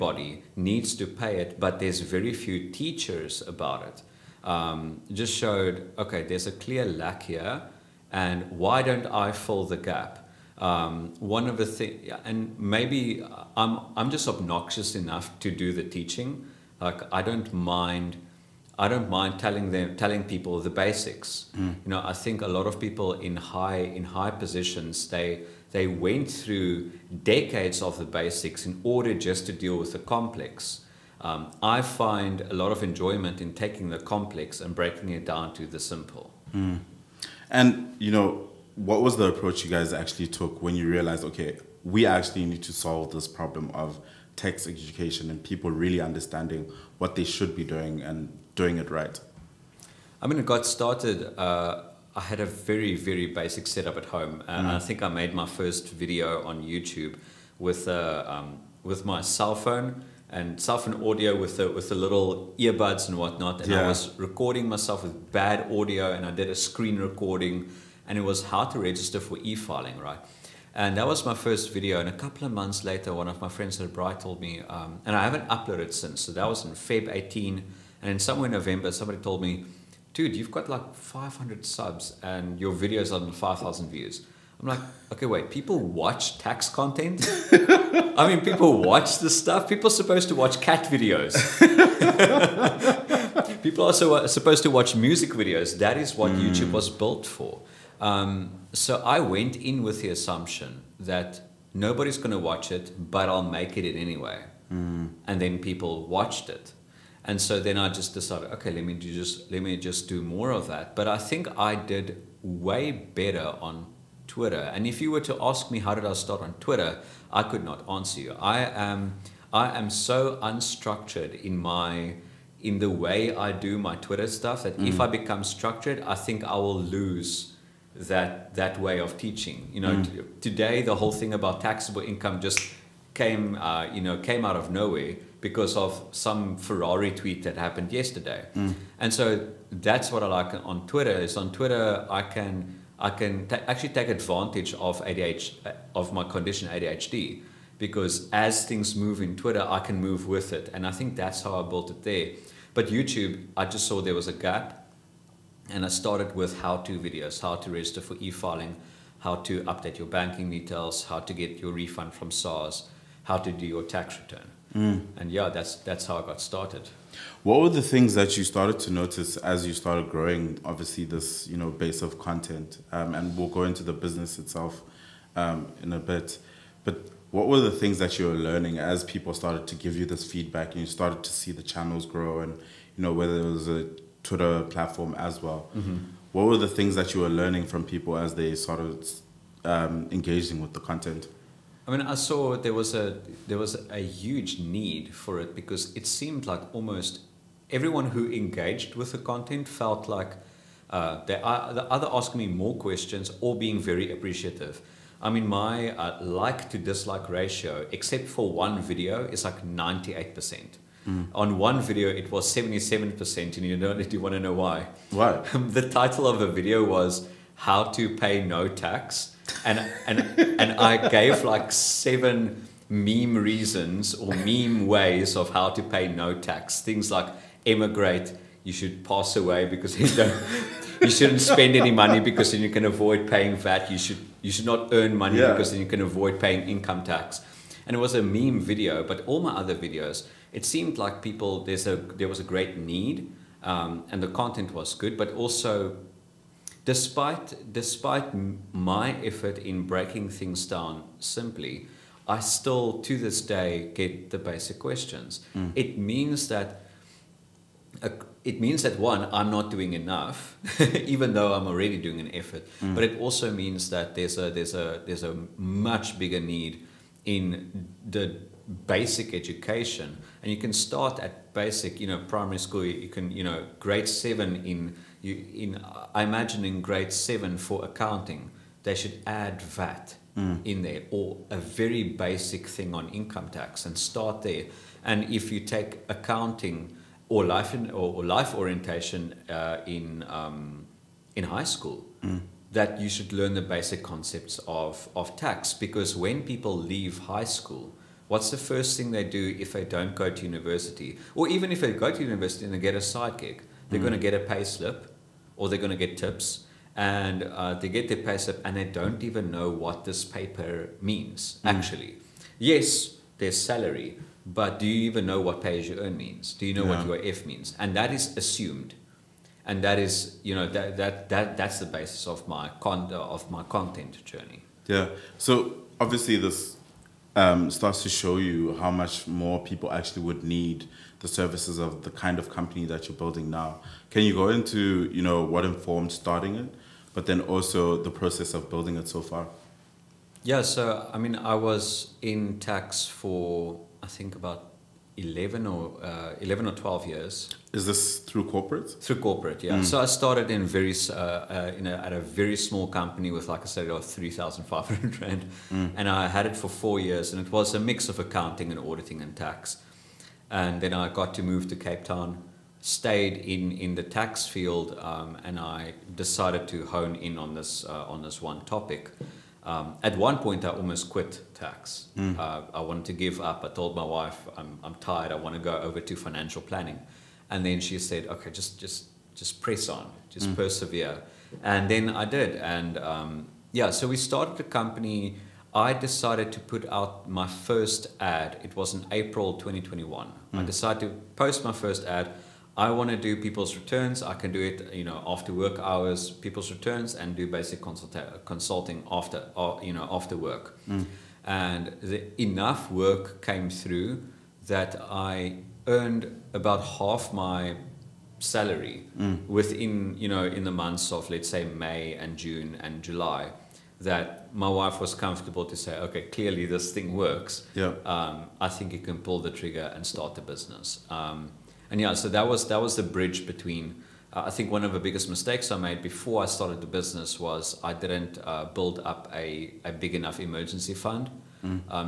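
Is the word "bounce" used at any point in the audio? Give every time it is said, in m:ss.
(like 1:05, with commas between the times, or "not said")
not said.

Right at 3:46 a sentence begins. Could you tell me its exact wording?
Things like emigrate, you should pass away because you don't you shouldn't spend any money because then you can avoid paying VAT.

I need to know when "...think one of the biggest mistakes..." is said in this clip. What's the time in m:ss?
7:04.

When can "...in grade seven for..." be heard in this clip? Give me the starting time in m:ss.
4:36.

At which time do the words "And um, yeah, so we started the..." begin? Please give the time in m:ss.
6:22.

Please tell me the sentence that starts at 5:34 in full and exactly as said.
Can you go into you know what informed starting it, but then also the process of building it so far?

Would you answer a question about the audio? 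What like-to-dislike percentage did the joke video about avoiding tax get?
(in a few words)
77%.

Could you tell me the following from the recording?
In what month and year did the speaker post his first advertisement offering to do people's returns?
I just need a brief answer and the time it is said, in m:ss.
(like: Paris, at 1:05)
April 2021, at 6:29.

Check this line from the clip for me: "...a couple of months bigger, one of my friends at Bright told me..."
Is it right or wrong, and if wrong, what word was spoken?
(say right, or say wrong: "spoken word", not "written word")
wrong: "later", not "bigger".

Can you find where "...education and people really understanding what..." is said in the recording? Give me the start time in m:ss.
0:44.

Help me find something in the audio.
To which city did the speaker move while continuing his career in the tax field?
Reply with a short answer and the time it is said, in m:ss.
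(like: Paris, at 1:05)
Cape Town, at 6:01.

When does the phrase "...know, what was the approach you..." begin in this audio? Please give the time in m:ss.
0:38.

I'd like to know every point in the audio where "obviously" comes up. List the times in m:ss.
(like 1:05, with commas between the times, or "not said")
2:50, 5:25.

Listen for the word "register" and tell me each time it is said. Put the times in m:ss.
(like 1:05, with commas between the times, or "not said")
1:08, 2:37.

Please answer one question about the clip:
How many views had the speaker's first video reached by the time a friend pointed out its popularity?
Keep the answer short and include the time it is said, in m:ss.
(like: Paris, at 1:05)
5,000, at 1:23.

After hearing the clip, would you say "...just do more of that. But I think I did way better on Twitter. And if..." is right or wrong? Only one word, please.
right.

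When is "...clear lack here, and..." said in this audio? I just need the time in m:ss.
0:06.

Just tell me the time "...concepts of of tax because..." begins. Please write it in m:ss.
4:54.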